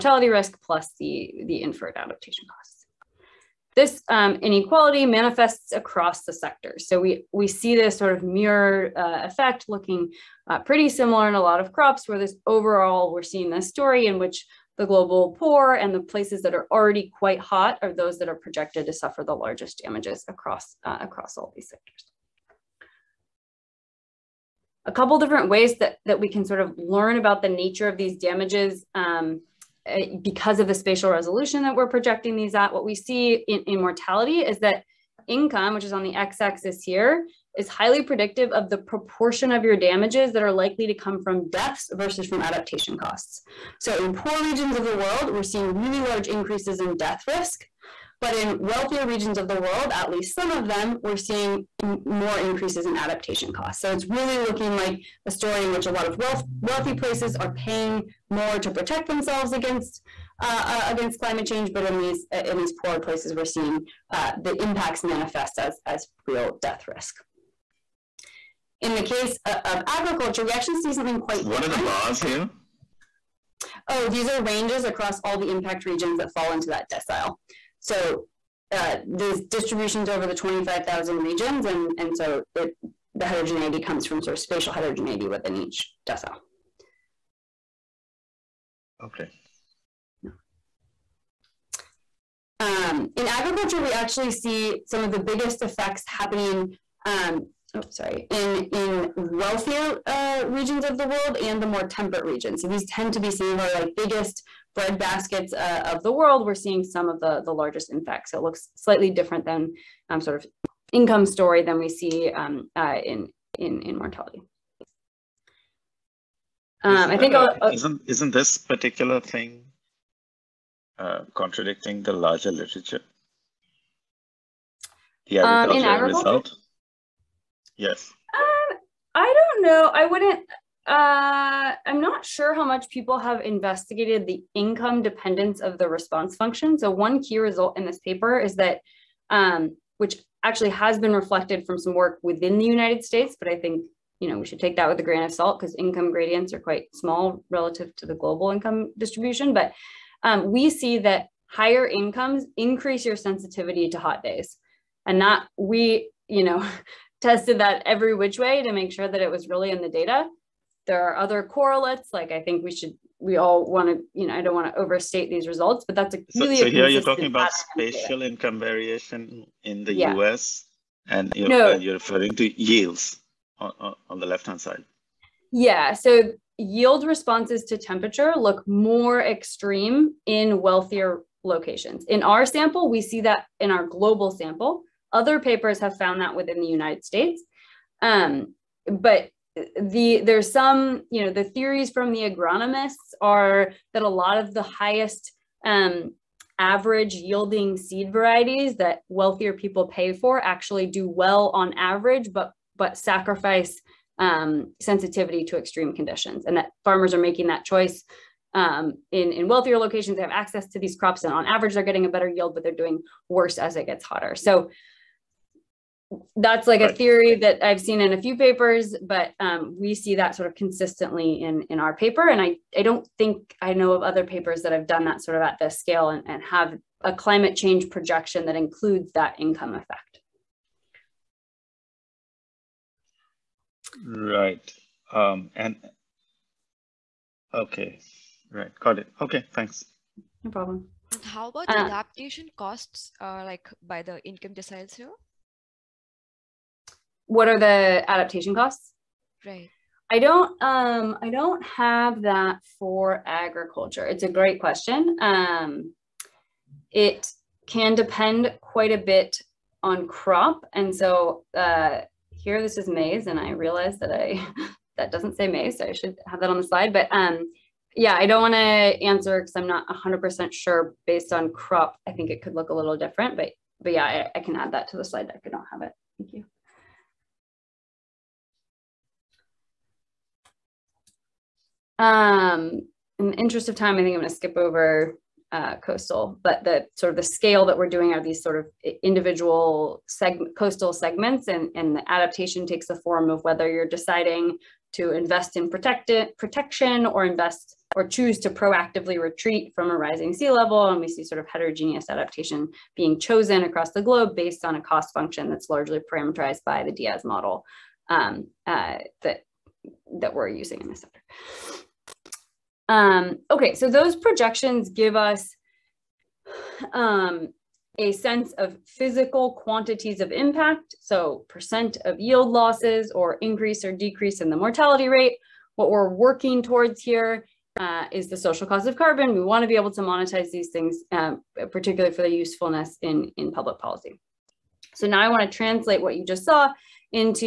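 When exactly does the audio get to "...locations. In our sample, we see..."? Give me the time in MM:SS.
03:01.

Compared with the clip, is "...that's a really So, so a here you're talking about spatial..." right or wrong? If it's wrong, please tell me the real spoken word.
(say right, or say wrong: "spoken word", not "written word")
right.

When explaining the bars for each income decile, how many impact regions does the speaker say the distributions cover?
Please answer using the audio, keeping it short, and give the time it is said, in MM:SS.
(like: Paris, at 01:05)
25,000, at 01:20.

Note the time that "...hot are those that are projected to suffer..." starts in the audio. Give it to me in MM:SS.
00:17.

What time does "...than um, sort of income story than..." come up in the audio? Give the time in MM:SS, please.
01:49.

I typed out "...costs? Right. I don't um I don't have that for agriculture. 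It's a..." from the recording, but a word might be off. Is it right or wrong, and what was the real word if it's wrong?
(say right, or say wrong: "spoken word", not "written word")
right.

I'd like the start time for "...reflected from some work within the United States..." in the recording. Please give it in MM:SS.
02:21.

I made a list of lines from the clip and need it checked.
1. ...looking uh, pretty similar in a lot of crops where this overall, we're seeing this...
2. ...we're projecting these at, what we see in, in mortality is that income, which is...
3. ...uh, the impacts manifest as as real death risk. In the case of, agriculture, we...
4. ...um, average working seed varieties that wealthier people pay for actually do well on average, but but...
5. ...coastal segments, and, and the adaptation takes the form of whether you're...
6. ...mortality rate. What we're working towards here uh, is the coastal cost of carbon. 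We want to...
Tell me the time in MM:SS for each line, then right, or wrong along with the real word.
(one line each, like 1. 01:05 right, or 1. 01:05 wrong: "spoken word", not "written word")
1. 00:09 right
2. 00:31 right
3. 01:04 right
4. 03:15 wrong: "yielding", not "working"
5. 04:50 right
6. 05:24 wrong: "social", not "coastal".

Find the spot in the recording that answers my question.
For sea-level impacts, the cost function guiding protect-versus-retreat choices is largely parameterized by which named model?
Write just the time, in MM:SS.
05:06.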